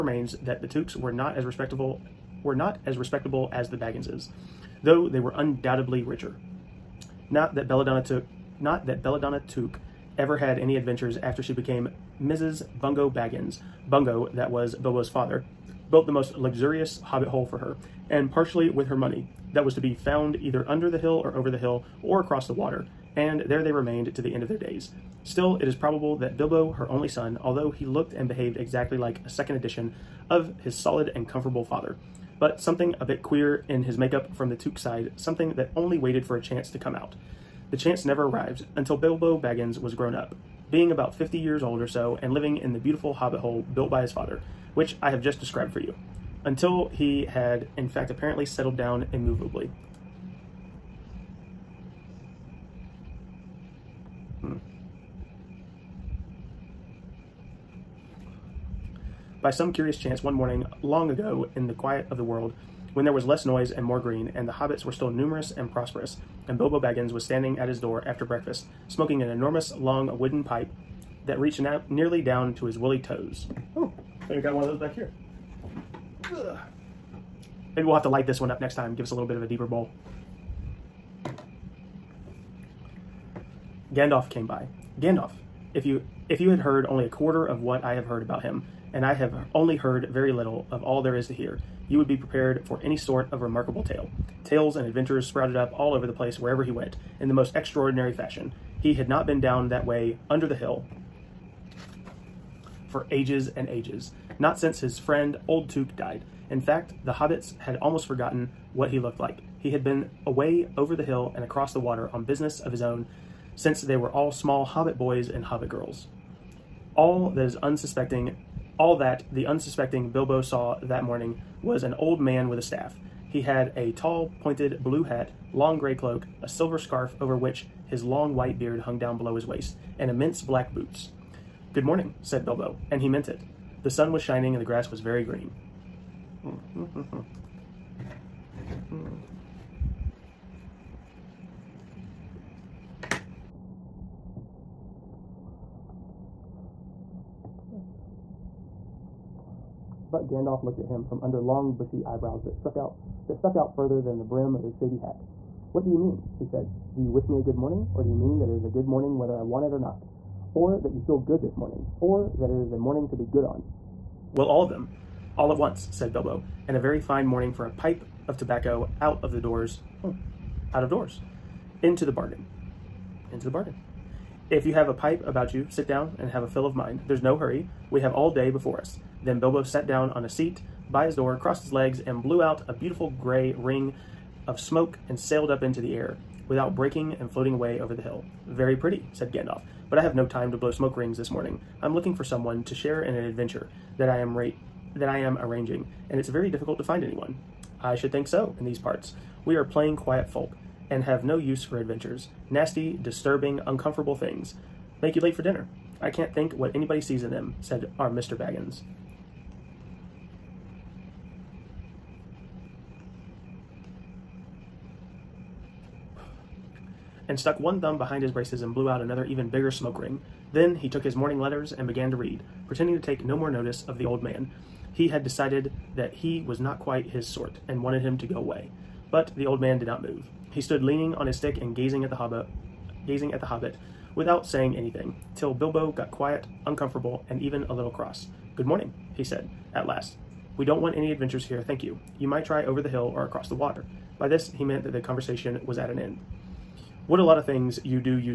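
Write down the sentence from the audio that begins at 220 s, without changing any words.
Then he took his morning letters and began to read, pretending to take no more notice of the old man.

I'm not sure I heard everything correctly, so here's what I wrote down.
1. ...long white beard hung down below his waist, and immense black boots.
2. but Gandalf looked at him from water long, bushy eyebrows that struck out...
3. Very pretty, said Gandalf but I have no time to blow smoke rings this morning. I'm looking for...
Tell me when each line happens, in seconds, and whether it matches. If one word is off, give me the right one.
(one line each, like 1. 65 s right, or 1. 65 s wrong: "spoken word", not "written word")
1. 128 s right
2. 150 s wrong: "under", not "water"
3. 188 s right.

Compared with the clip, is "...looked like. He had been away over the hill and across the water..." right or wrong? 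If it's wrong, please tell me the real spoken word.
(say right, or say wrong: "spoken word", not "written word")
right.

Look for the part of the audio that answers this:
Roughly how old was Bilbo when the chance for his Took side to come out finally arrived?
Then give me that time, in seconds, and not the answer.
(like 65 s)
40 s.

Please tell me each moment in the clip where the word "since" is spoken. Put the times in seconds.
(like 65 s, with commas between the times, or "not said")
104 s, 113 s.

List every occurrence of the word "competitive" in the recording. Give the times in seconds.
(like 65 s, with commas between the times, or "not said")
not said.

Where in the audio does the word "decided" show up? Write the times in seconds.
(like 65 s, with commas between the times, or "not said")
225 s.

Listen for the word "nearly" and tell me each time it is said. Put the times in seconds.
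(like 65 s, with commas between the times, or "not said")
71 s.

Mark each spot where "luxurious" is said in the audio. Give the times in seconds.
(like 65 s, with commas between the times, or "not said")
16 s.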